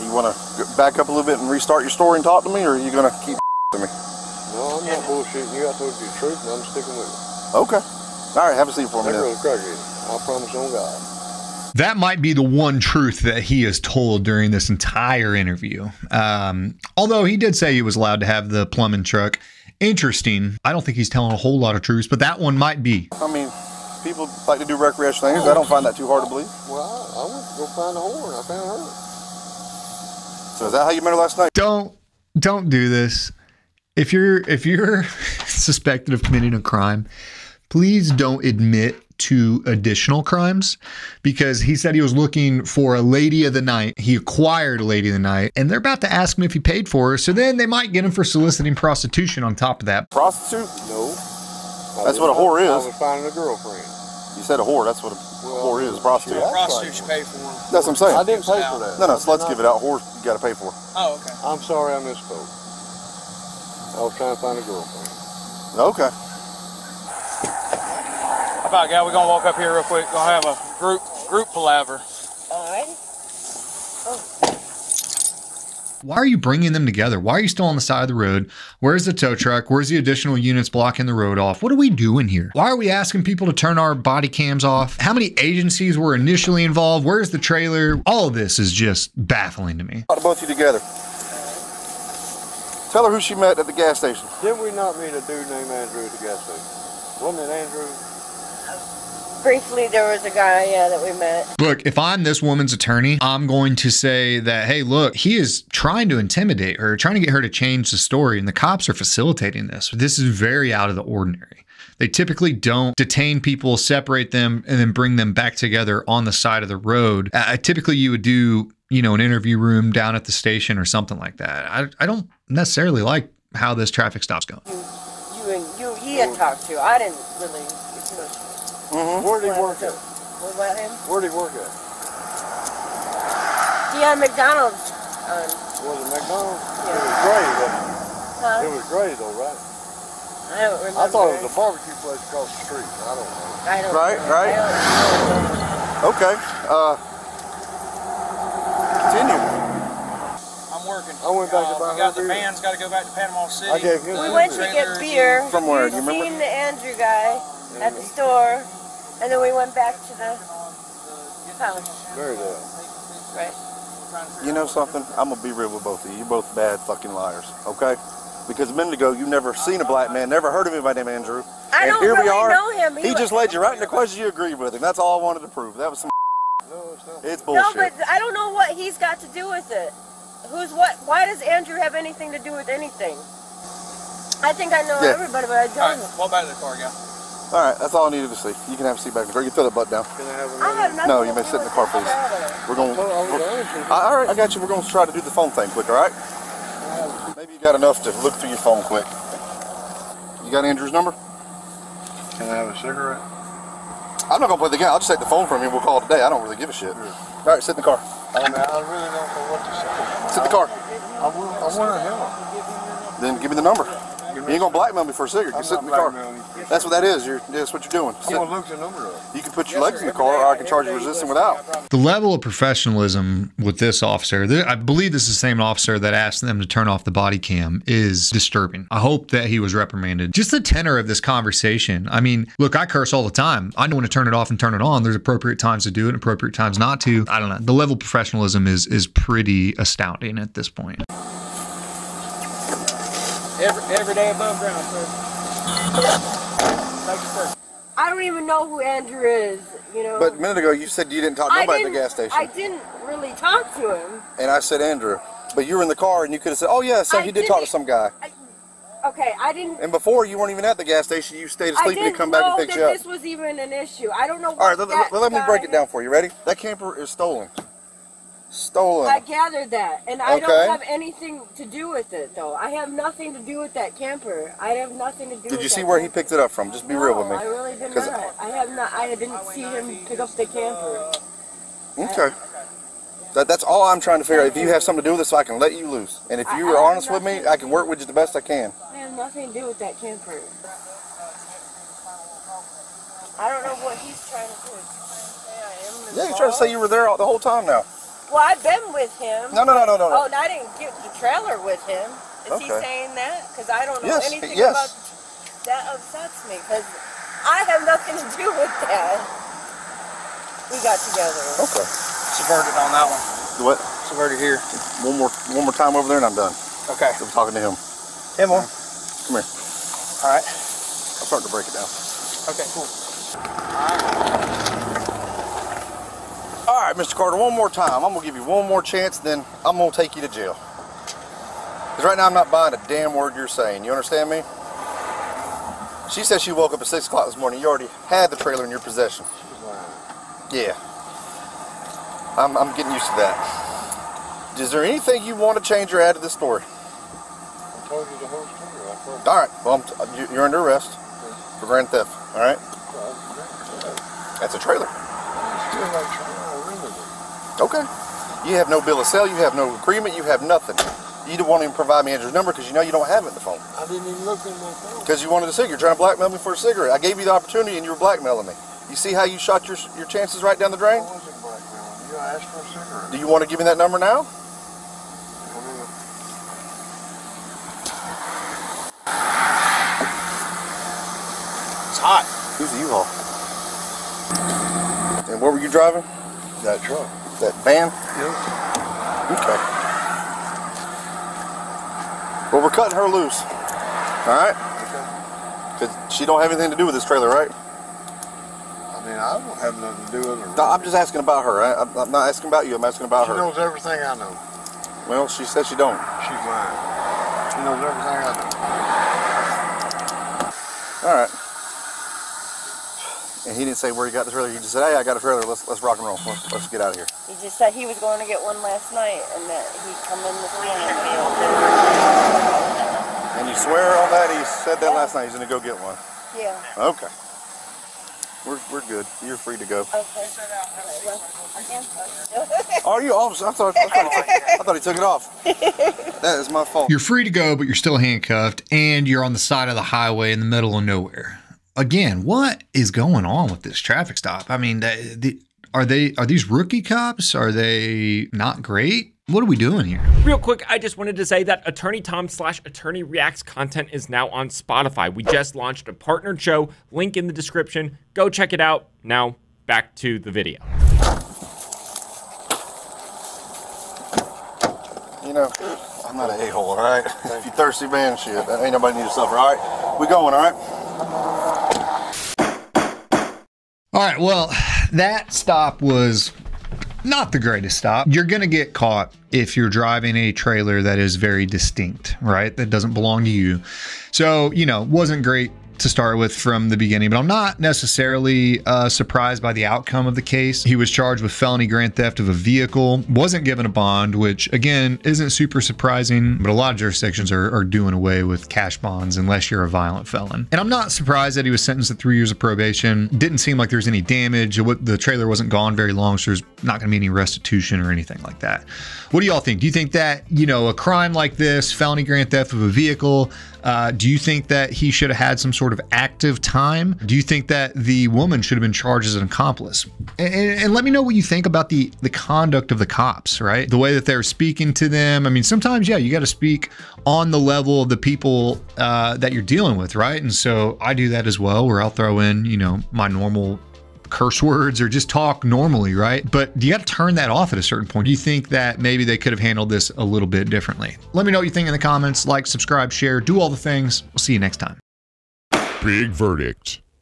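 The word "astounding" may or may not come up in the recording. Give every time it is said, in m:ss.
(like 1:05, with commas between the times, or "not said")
3:59.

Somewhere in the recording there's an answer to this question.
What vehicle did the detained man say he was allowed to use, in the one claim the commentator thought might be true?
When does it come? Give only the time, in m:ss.
0:18.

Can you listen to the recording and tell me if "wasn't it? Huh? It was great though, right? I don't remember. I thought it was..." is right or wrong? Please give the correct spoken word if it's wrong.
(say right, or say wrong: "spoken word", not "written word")
right.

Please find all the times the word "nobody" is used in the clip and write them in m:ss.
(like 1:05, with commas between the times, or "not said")
4:11, 7:48.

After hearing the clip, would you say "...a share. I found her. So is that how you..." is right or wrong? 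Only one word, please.
wrong.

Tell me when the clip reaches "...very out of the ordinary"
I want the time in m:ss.
1:50.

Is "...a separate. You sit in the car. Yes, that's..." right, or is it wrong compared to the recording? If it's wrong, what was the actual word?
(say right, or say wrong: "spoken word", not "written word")
wrong: "cigarette", not "separate".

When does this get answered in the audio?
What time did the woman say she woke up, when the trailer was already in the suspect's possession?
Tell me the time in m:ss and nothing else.
5:36.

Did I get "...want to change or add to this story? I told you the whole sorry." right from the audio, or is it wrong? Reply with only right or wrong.
wrong.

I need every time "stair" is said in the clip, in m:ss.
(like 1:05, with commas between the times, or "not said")
not said.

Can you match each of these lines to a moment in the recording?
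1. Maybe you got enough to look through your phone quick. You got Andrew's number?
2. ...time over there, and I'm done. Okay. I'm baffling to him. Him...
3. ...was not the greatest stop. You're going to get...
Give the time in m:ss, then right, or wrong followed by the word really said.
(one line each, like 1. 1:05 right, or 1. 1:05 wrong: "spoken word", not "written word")
1. 3:17 right
2. 5:15 wrong: "talking", not "baffling"
3. 7:55 right.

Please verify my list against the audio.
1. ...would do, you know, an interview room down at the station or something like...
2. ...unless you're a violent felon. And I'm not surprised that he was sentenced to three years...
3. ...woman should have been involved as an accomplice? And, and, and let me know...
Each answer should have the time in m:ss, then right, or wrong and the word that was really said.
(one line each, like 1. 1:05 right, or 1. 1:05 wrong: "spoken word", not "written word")
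1. 1:58 right
2. 8:19 right
3. 8:38 wrong: "charged", not "involved".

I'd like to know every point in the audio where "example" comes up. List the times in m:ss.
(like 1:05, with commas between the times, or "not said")
not said.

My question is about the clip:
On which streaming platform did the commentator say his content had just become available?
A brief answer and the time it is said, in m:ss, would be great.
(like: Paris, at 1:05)
Spotify, at 7:34.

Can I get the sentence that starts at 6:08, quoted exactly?
You see how you shot your your chances right down the drain?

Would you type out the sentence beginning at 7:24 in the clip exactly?
I mean, the, the, are they are these rookie cops?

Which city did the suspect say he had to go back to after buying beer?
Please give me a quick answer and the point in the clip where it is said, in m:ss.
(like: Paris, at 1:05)
Panama City, at 2:33.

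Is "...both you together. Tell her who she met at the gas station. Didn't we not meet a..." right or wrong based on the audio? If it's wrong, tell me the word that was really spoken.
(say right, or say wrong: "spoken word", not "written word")
right.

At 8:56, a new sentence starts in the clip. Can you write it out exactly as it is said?
But you got to turn that off at a certain point.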